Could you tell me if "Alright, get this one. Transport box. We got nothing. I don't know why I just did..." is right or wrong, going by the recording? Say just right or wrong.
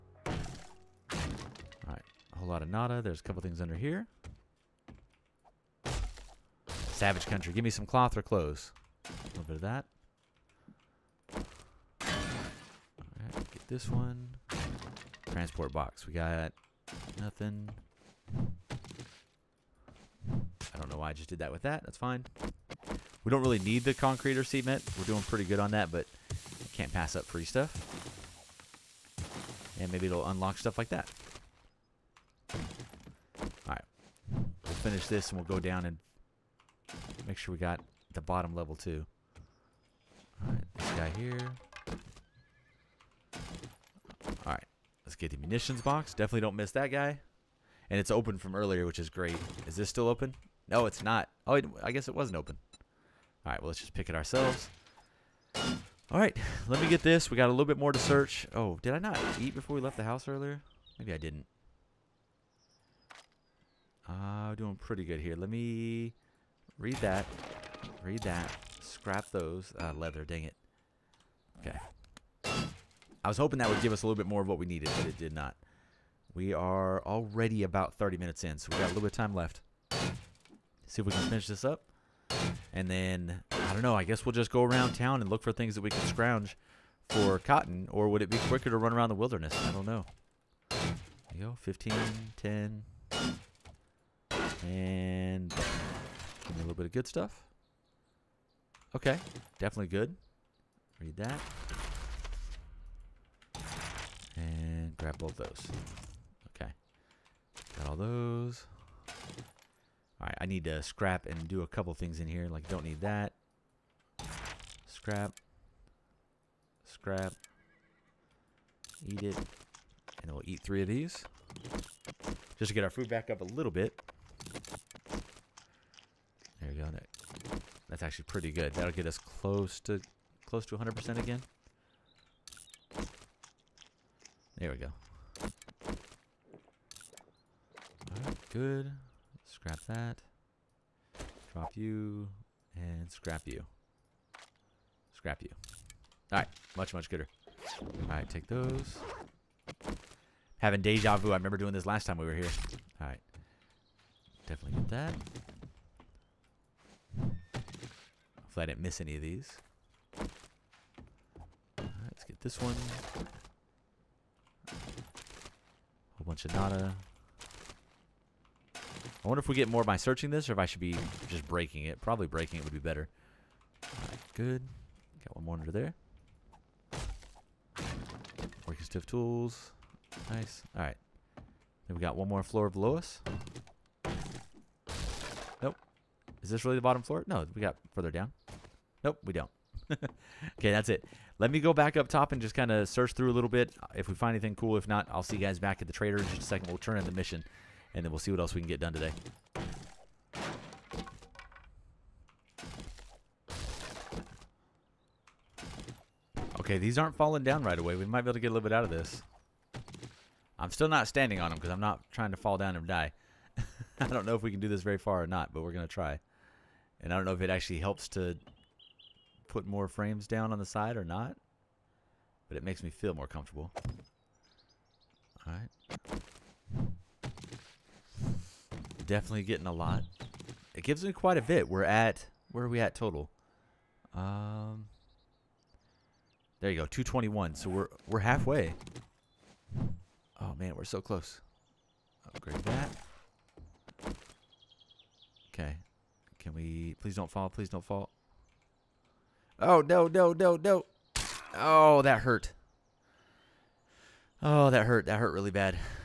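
right.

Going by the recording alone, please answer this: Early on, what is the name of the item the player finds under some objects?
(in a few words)
Savage Country.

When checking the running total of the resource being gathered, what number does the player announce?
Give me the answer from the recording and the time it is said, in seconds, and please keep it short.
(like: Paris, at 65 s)
221, at 236 s.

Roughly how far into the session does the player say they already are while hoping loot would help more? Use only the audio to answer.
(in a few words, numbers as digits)
30 minutes.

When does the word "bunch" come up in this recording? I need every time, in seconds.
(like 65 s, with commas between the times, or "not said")
166 s.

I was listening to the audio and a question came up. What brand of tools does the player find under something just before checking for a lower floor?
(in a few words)
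Working Stiff.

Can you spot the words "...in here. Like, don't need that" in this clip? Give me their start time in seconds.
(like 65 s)
112 s.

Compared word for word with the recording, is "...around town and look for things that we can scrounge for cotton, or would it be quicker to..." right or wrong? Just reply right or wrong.
right.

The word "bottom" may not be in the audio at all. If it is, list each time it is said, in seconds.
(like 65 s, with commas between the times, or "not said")
38 s, 186 s.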